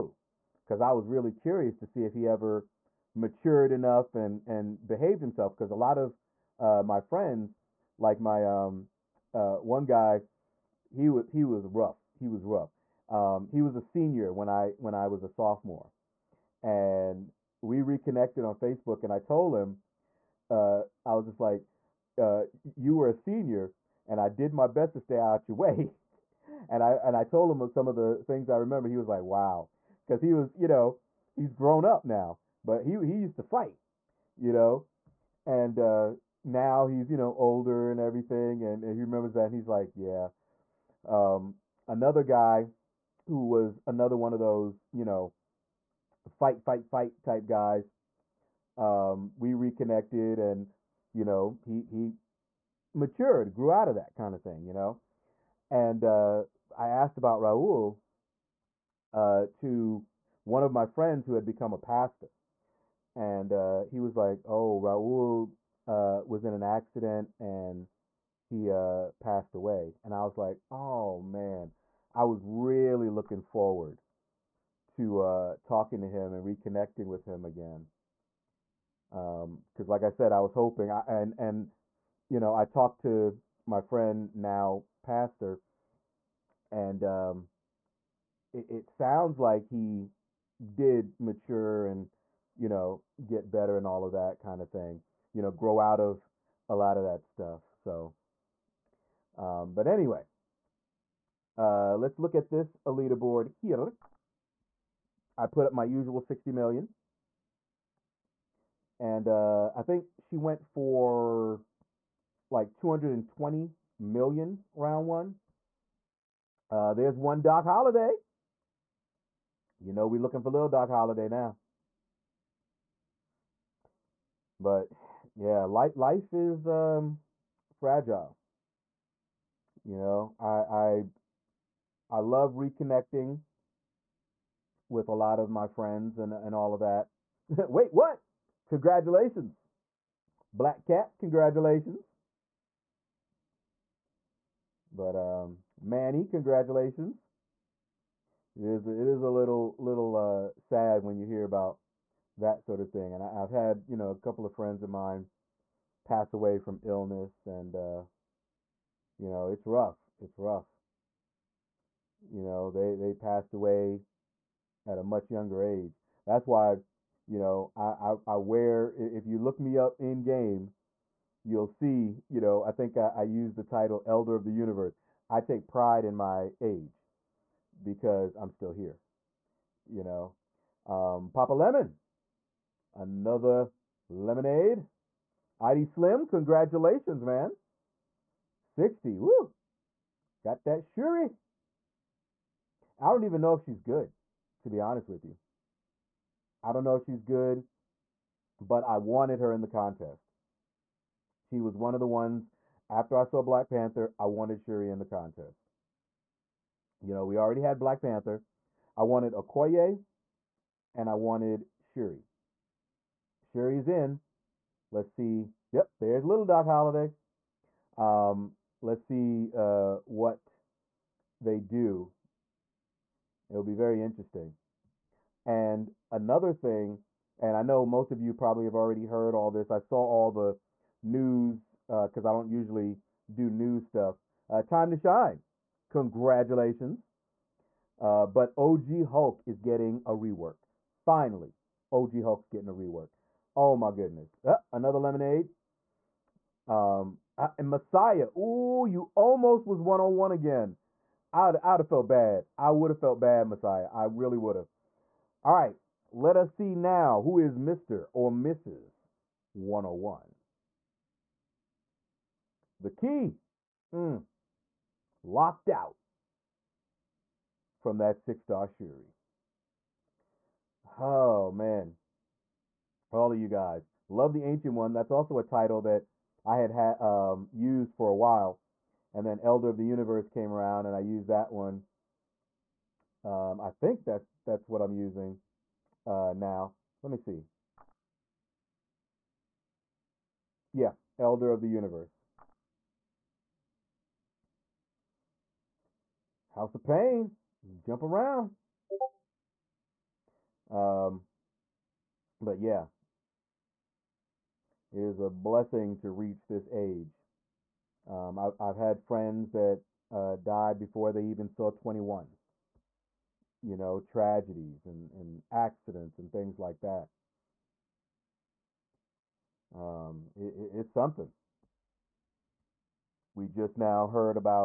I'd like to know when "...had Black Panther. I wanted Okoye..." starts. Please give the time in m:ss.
3:27.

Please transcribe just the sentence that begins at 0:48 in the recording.
Um, we reconnected and, you know, he, he matured, grew out of that kind of thing, you know?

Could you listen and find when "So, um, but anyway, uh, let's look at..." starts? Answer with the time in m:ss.
1:37.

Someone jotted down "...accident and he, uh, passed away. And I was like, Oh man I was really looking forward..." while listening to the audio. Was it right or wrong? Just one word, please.
right.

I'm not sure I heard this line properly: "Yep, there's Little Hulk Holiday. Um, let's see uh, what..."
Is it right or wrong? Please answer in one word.
wrong.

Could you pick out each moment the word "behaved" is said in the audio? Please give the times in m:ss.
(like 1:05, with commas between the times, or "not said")
0:04.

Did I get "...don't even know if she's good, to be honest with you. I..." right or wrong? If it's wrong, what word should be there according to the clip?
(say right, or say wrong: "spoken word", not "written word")
right.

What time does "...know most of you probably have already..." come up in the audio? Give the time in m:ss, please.
3:47.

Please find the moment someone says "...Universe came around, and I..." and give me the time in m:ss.
4:39.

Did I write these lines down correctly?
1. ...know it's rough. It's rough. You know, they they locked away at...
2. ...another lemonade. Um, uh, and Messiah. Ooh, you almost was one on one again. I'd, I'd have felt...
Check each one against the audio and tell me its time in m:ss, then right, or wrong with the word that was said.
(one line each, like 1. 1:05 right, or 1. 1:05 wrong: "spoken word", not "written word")
1. 2:39 wrong: "passed", not "locked"
2. 4:04 right.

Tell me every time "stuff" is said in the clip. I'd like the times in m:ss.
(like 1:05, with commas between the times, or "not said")
1:37, 3:53.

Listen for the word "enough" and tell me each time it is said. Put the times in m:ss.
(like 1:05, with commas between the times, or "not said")
0:03.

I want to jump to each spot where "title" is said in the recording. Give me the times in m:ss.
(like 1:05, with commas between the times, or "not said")
2:53, 4:35.